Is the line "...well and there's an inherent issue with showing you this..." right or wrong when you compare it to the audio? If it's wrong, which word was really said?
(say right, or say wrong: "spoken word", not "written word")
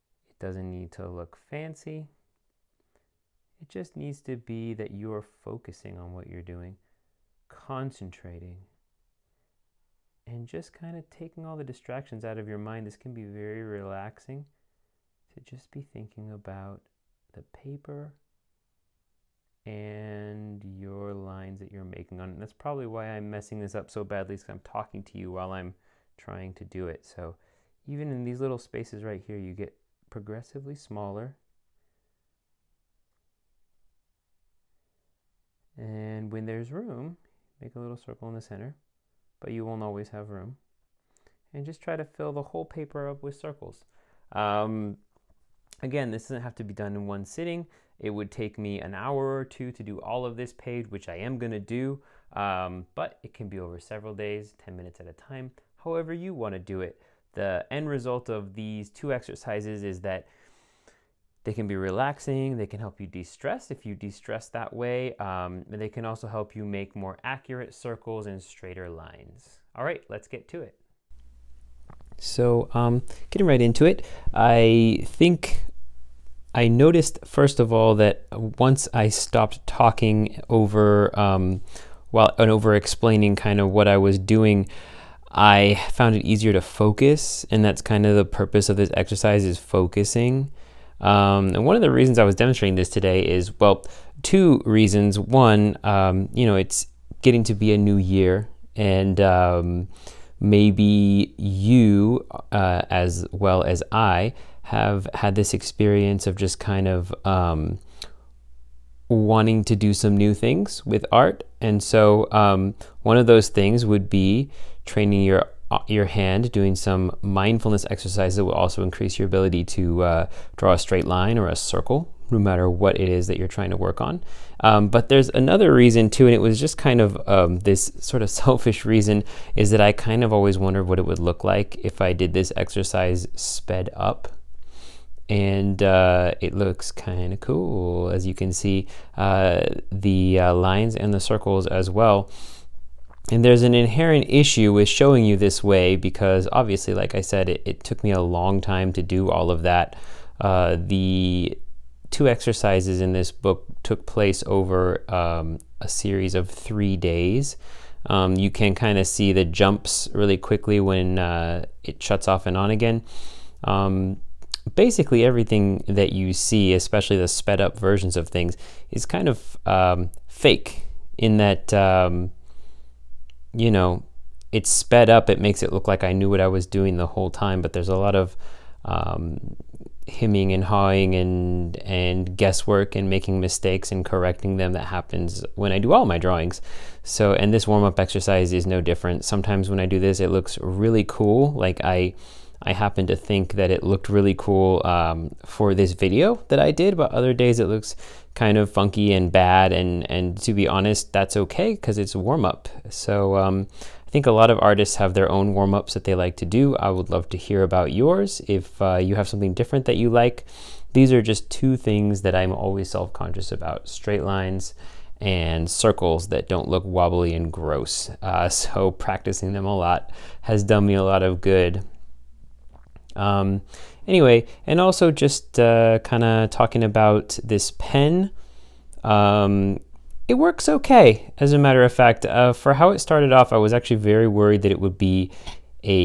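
right.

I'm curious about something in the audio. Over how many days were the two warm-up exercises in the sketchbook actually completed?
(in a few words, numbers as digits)
3.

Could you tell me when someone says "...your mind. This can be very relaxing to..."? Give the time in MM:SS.
00:12.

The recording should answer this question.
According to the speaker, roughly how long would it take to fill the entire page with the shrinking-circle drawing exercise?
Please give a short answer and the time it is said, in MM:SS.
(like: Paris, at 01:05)
an hour or two, at 00:48.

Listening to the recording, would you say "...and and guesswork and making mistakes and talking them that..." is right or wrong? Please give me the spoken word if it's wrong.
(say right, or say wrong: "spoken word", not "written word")
wrong: "correcting", not "talking".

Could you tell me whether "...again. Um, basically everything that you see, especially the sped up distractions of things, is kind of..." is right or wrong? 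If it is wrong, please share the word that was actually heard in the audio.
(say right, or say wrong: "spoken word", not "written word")
wrong: "versions", not "distractions".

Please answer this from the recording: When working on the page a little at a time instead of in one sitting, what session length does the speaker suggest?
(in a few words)
10 minutes.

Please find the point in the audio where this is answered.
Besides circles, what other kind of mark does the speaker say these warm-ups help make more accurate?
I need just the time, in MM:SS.
01:08.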